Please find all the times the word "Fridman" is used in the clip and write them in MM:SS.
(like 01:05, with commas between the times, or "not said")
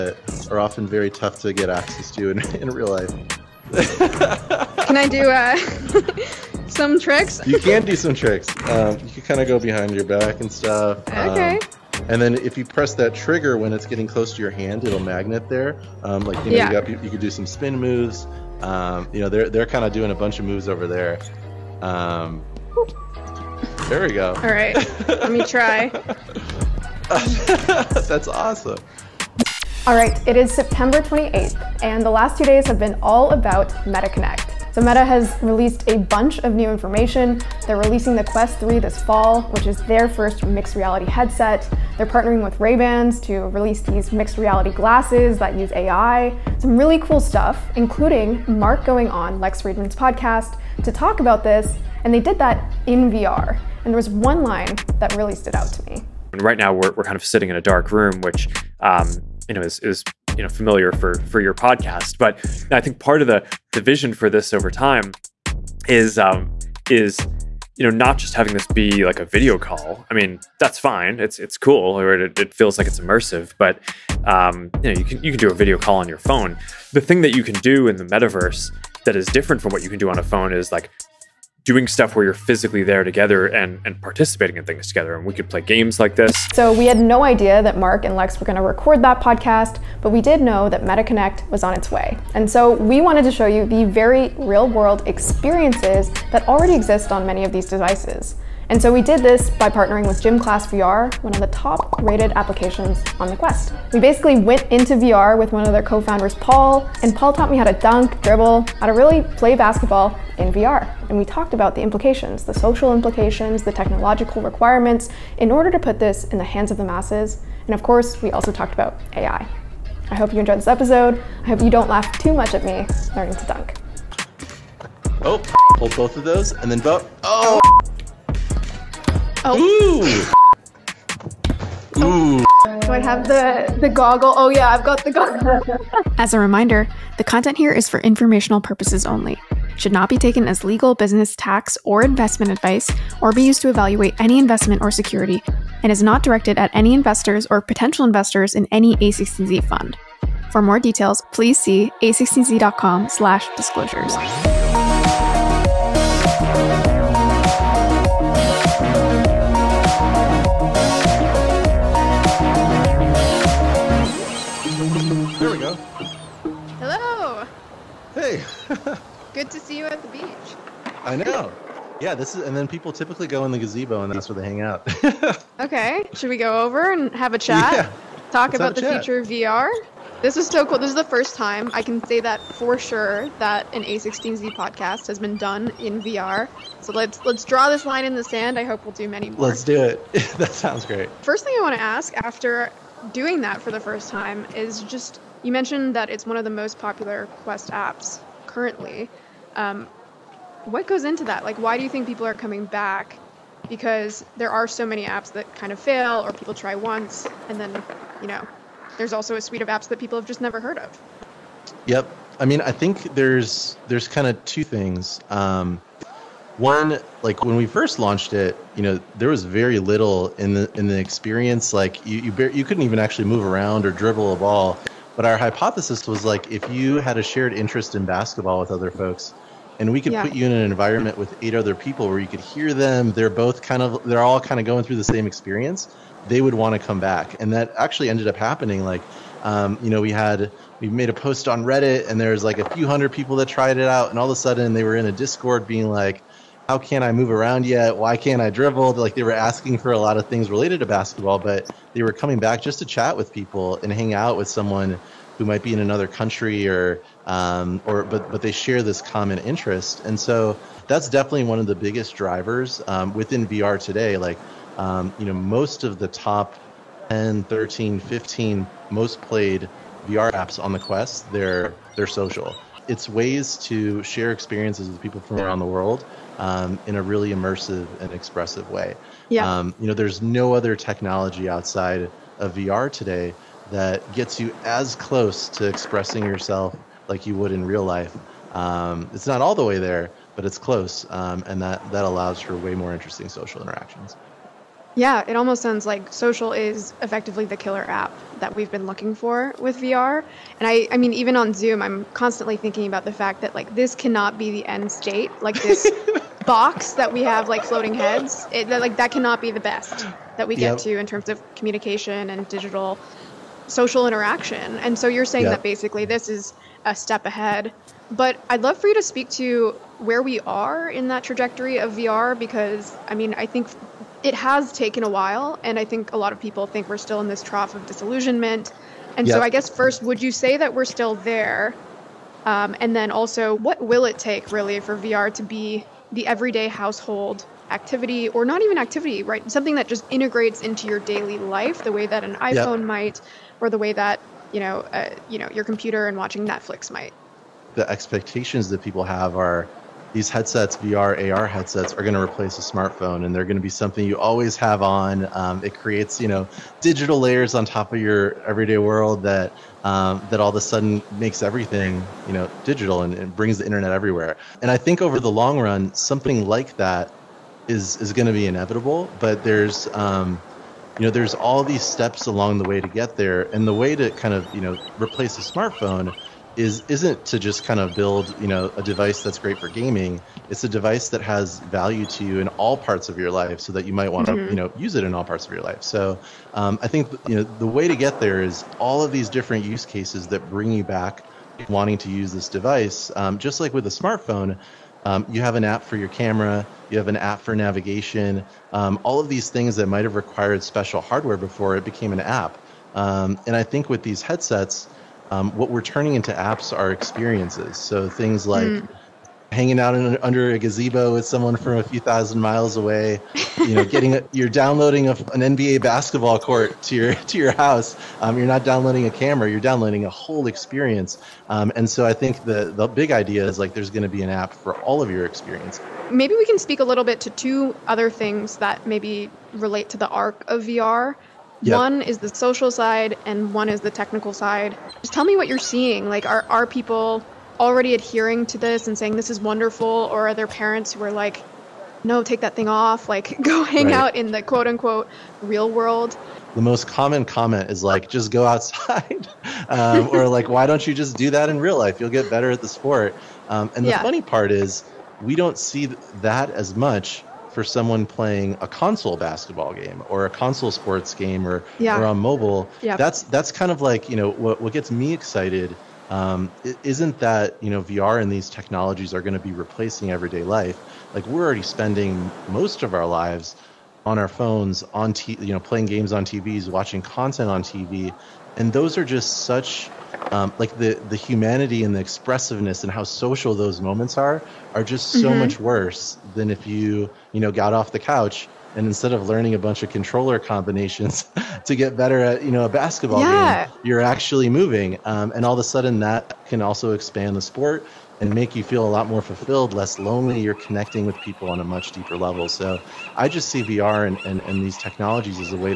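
00:49.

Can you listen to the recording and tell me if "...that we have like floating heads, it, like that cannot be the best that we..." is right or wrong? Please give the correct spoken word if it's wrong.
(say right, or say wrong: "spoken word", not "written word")
right.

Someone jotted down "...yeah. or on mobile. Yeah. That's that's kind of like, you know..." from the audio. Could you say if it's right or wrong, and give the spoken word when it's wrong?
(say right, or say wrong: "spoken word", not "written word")
right.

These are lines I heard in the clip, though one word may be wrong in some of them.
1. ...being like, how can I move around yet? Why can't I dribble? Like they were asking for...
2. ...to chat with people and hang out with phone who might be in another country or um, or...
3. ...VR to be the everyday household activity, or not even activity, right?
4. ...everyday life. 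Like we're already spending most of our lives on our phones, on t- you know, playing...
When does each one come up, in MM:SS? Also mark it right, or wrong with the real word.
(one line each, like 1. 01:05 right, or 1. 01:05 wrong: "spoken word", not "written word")
1. 04:05 right
2. 04:12 wrong: "someone", not "phone"
3. 05:34 right
4. 07:50 right.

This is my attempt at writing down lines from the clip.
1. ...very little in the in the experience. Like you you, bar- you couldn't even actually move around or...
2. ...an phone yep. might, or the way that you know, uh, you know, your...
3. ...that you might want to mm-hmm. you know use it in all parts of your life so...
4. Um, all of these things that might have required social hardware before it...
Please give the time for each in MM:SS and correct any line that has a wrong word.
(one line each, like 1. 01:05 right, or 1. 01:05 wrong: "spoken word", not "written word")
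1. 03:39 right
2. 05:42 wrong: "iPhone", not "phone"
3. 06:23 right
4. 06:38 wrong: "special", not "social".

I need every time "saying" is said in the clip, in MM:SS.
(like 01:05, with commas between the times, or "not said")
05:15, 07:18.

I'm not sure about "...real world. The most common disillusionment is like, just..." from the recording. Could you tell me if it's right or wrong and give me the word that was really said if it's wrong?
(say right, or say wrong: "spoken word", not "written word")
wrong: "comment", not "disillusionment".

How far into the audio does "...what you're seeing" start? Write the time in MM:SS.
07:15.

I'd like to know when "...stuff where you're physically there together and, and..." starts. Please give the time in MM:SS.
01:21.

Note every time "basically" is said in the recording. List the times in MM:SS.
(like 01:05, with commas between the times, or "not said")
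01:43, 05:15.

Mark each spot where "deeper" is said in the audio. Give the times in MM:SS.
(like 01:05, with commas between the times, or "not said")
08:21.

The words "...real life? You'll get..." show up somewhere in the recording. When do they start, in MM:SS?
07:31.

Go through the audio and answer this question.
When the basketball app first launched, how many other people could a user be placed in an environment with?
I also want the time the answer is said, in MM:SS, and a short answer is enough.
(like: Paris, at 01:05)
8, at 03:51.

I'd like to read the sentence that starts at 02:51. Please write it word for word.
Yeah, this is, and then people typically go in the gazebo, and that's where they hang out.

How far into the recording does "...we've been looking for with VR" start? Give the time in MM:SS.
04:58.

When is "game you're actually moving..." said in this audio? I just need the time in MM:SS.
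08:13.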